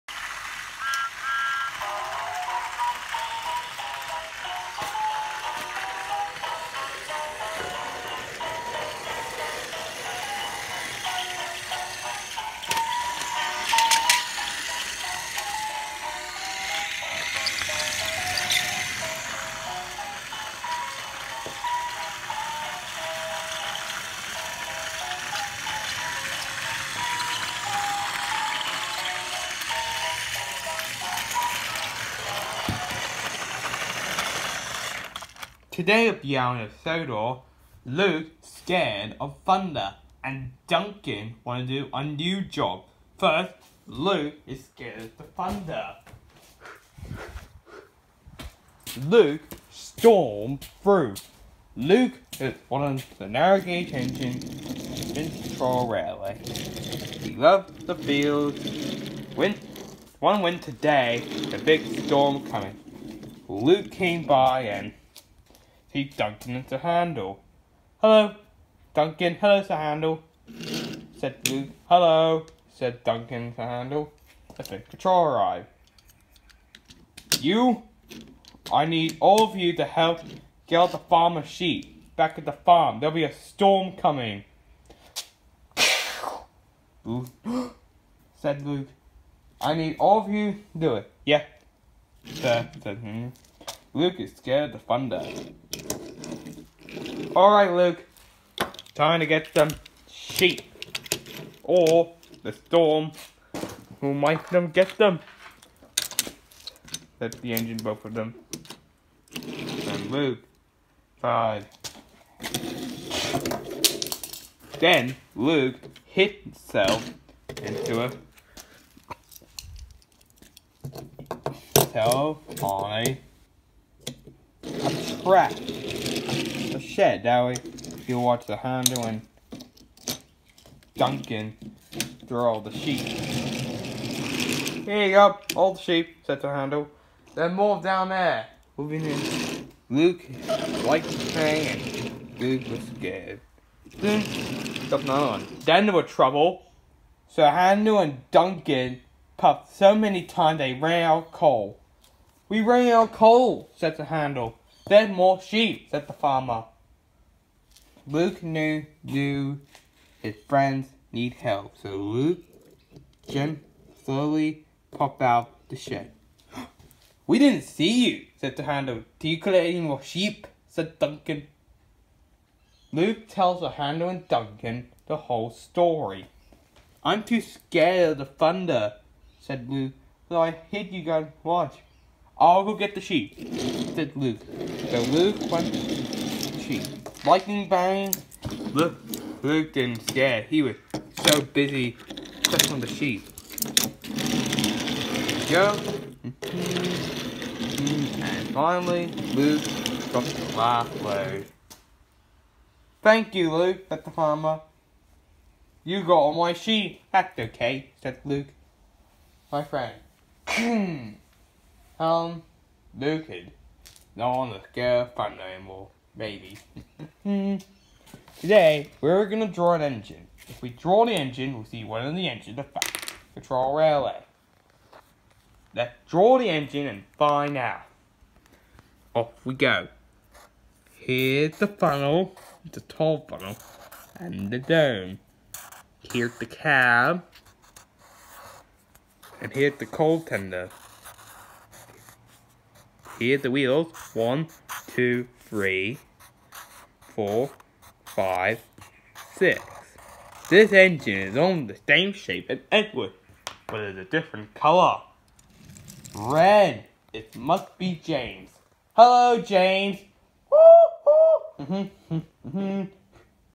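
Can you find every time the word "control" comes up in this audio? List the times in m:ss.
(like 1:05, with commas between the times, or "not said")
0:55, 1:14.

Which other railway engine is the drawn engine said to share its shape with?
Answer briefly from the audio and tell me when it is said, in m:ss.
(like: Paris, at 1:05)
Edward, at 4:12.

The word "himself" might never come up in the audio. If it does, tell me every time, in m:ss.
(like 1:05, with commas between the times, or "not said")
1:56, 2:01.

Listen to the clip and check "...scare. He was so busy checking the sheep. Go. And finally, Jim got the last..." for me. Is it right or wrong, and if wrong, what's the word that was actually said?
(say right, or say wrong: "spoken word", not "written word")
wrong: "Luke", not "Jim".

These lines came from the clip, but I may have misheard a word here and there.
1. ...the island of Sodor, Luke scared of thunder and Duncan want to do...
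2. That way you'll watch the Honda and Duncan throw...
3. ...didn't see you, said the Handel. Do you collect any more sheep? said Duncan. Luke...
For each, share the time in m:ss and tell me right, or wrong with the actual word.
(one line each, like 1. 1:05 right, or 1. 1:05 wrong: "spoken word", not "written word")
1. 0:36 right
2. 2:07 right
3. 2:47 right.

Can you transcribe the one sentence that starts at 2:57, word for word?
I'm too scared of the thunder, said Luke, so I hid you guys watch.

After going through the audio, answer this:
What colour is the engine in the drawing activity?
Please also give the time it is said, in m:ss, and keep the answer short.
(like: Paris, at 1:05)
Red, at 4:16.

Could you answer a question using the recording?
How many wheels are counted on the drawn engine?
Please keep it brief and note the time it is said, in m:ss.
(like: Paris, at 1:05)
6, at 4:09.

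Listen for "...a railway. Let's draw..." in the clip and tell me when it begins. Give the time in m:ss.
3:43.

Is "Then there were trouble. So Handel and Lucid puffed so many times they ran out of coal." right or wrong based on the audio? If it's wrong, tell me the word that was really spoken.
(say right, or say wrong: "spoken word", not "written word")
wrong: "Duncan", not "Lucid".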